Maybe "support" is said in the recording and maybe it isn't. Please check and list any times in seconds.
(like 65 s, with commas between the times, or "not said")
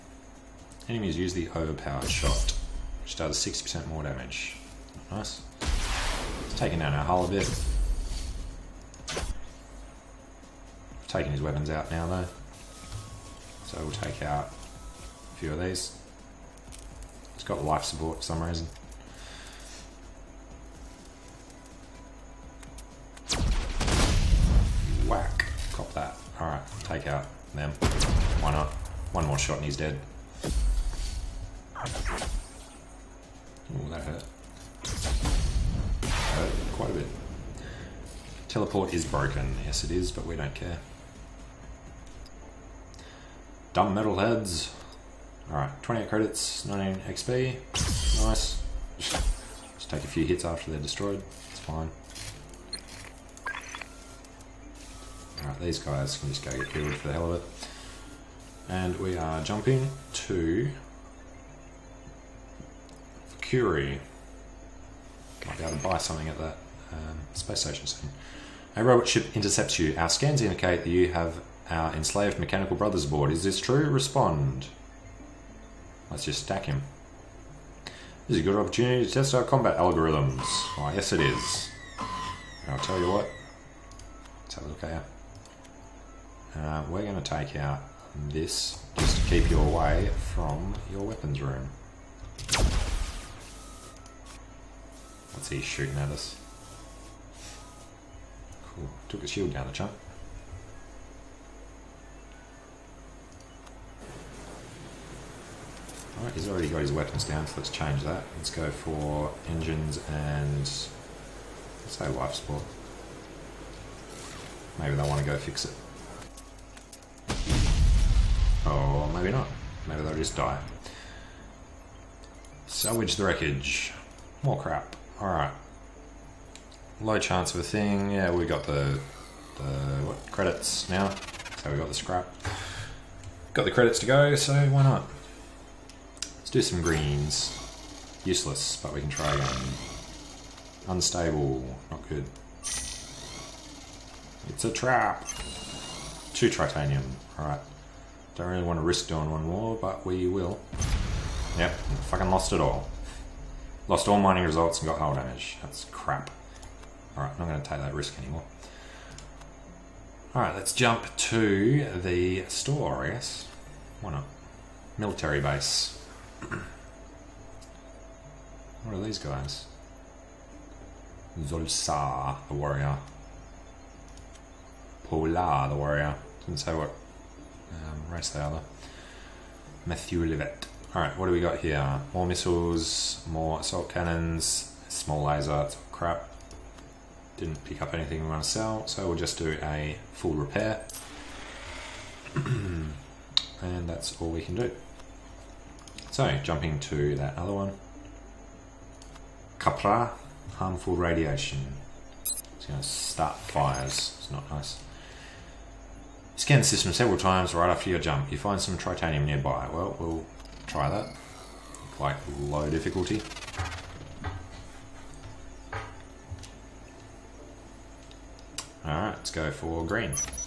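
17 s, 112 s.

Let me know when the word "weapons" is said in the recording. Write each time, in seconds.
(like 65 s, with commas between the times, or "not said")
11 s, 91 s, 106 s.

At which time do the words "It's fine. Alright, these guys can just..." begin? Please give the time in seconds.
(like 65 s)
51 s.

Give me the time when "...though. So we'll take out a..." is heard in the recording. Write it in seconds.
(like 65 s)
12 s.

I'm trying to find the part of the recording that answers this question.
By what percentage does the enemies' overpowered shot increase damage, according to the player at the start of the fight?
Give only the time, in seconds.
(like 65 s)
3 s.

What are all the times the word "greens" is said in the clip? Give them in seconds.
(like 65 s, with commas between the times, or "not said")
136 s, 219 s.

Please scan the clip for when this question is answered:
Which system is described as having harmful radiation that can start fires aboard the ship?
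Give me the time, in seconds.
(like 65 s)
199 s.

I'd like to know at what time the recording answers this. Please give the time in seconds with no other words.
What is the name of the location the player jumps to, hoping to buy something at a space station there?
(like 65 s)
63 s.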